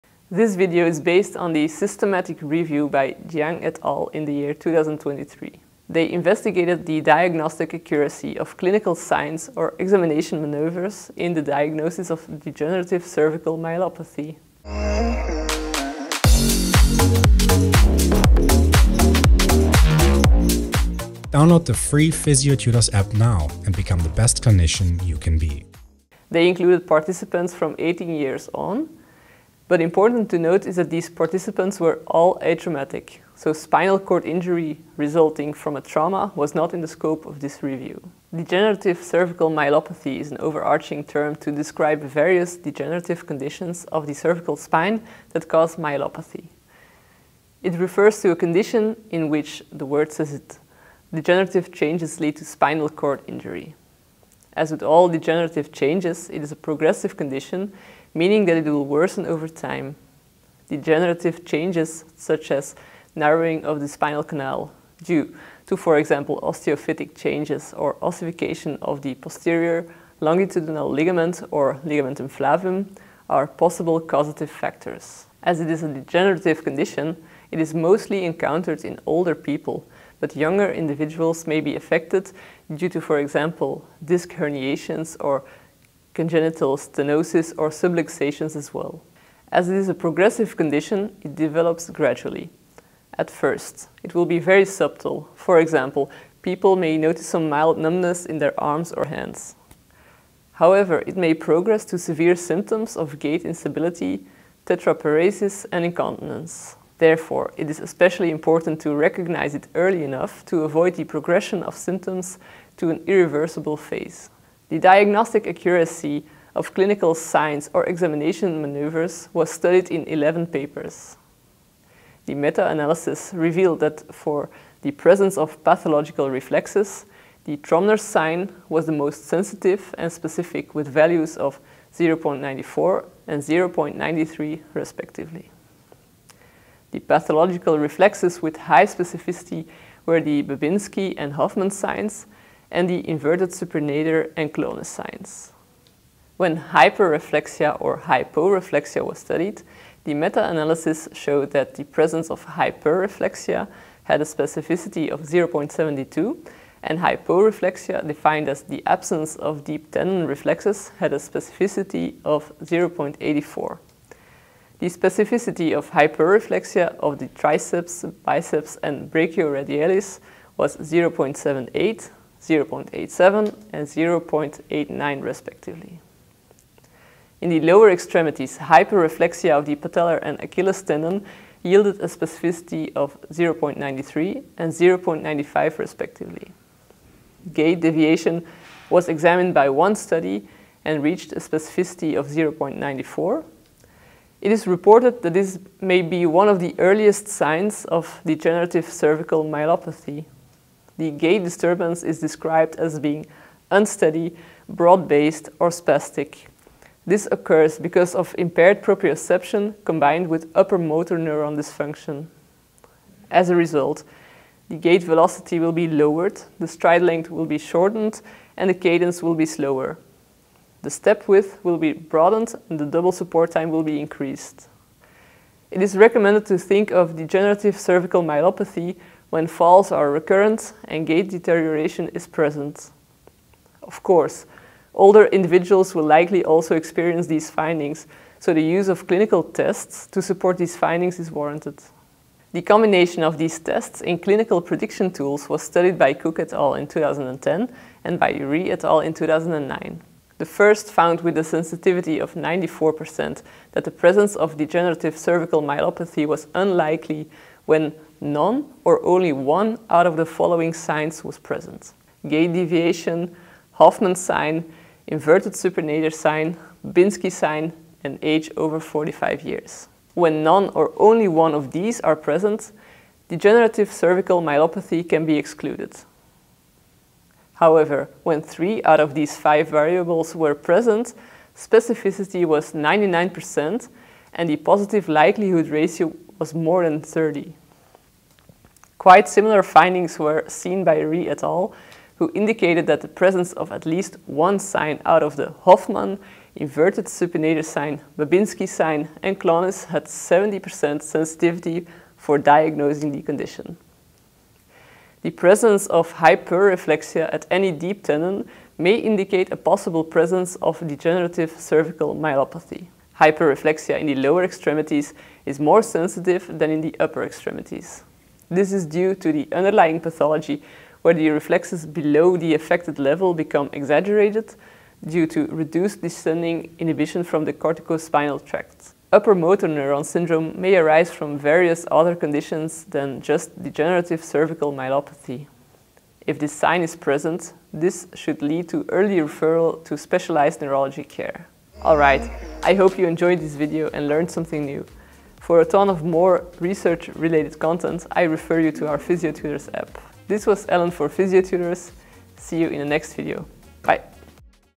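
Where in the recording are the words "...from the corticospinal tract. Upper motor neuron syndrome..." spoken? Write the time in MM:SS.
05:27.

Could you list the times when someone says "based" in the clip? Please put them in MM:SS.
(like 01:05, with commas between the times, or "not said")
00:01, 03:24.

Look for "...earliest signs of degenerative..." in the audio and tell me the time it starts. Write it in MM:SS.
03:16.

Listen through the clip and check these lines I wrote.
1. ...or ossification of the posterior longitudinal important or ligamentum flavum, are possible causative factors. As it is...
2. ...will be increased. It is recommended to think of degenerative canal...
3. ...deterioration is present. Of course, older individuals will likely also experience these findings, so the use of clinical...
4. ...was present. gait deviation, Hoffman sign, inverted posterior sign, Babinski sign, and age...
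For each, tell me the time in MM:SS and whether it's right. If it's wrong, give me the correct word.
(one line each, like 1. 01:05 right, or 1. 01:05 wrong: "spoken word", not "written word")
1. 01:07 wrong: "ligament", not "important"
2. 03:43 wrong: "cervical", not "canal"
3. 03:51 right
4. 04:21 wrong: "supinator", not "posterior".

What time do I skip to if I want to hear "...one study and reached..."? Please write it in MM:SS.
03:09.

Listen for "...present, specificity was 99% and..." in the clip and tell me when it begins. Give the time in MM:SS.
04:40.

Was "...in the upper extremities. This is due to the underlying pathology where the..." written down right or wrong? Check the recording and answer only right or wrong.
right.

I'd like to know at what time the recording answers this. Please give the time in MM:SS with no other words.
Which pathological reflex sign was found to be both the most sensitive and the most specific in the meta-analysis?
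02:07.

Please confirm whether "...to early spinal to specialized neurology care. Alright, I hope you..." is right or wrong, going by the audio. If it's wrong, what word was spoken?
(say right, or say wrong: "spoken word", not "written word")
wrong: "referral", not "spinal".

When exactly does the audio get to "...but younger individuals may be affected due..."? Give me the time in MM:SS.
01:20.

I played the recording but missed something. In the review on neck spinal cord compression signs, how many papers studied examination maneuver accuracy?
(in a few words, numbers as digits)
11.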